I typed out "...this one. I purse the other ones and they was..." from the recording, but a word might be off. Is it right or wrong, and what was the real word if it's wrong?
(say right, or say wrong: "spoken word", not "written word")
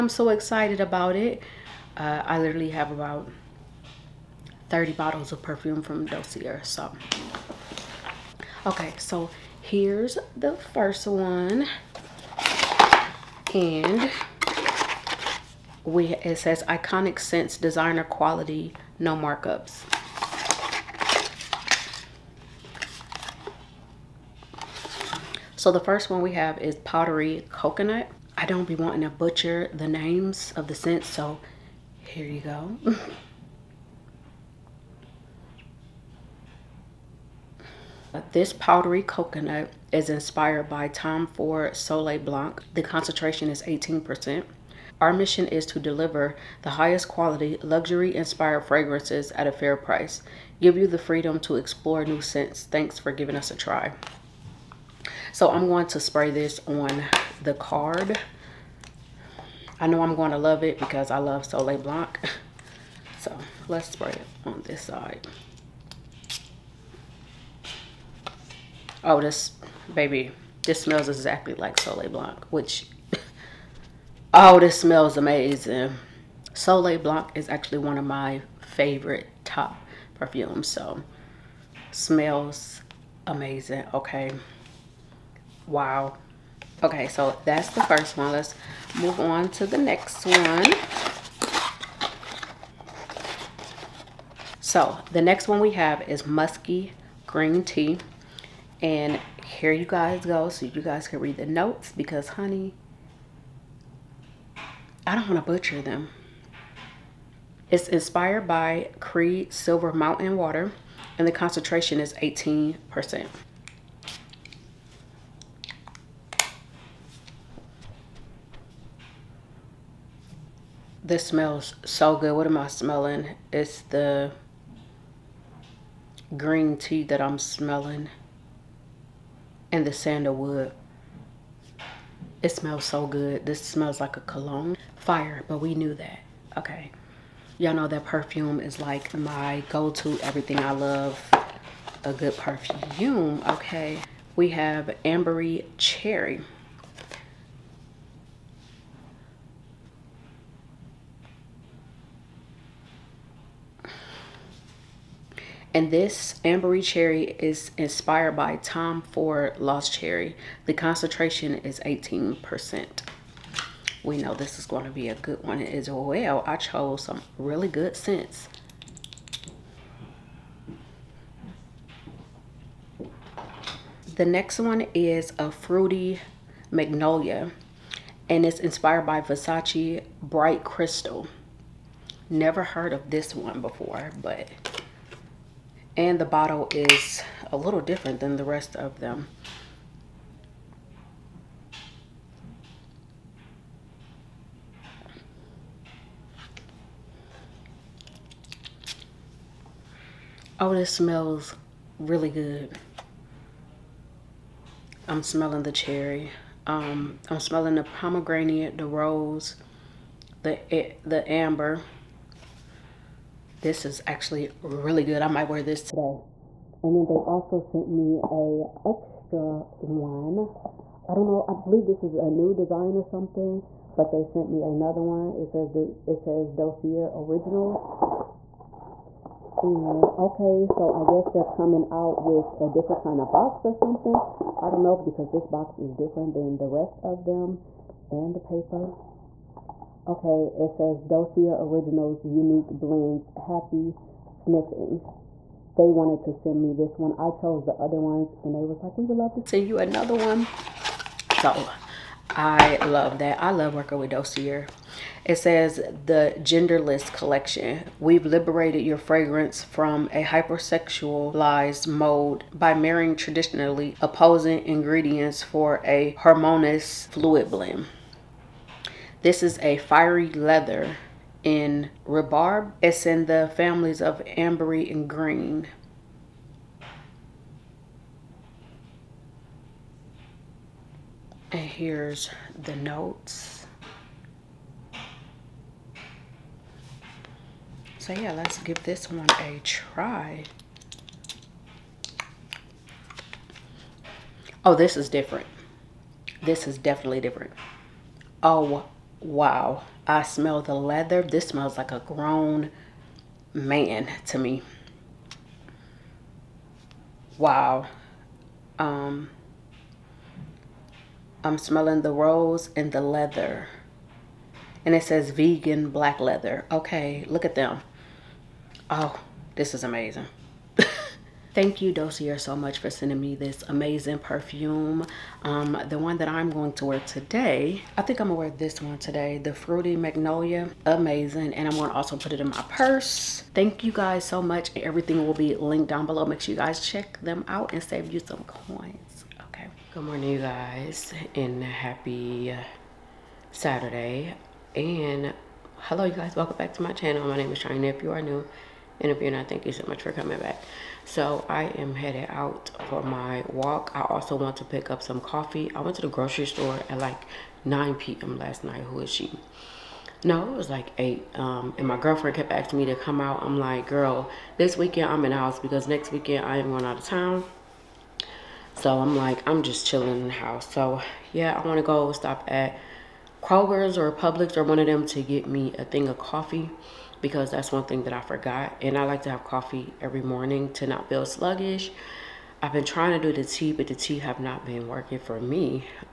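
wrong: "chose", not "purse".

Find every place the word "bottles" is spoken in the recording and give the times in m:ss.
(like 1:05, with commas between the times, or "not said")
0:04, 3:06.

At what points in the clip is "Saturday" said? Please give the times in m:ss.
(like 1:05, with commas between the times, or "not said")
5:43.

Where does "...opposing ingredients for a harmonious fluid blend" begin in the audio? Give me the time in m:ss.
4:23.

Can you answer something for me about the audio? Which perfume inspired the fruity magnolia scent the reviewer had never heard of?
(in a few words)
Versace Bright Crystal.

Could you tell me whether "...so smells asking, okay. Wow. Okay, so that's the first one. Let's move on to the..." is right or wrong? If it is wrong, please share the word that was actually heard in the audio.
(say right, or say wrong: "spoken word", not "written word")
wrong: "amazing", not "asking".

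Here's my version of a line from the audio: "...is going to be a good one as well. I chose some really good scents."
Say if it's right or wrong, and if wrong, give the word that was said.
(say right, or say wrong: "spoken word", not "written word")
right.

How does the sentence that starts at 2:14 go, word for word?
Fire, but we knew that, okay.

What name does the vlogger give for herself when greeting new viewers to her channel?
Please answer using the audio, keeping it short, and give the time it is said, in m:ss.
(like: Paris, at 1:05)
Chyna, at 5:47.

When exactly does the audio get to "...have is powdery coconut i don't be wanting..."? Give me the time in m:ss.
0:26.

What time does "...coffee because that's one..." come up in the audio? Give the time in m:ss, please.
6:16.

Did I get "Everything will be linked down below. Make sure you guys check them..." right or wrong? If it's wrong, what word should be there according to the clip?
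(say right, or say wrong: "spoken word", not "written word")
right.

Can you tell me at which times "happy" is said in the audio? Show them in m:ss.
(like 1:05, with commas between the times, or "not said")
4:03, 5:41.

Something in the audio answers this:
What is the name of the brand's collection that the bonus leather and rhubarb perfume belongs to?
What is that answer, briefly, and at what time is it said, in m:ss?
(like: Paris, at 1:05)
the genderless collection, at 4:16.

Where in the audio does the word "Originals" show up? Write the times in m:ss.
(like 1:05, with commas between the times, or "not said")
3:47, 4:01.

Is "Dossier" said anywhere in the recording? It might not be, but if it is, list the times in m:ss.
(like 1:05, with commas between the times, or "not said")
0:06, 3:46, 4:01, 4:14, 5:21.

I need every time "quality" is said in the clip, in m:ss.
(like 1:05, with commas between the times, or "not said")
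0:18, 0:47.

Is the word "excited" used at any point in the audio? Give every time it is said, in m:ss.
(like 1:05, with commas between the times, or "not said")
0:00.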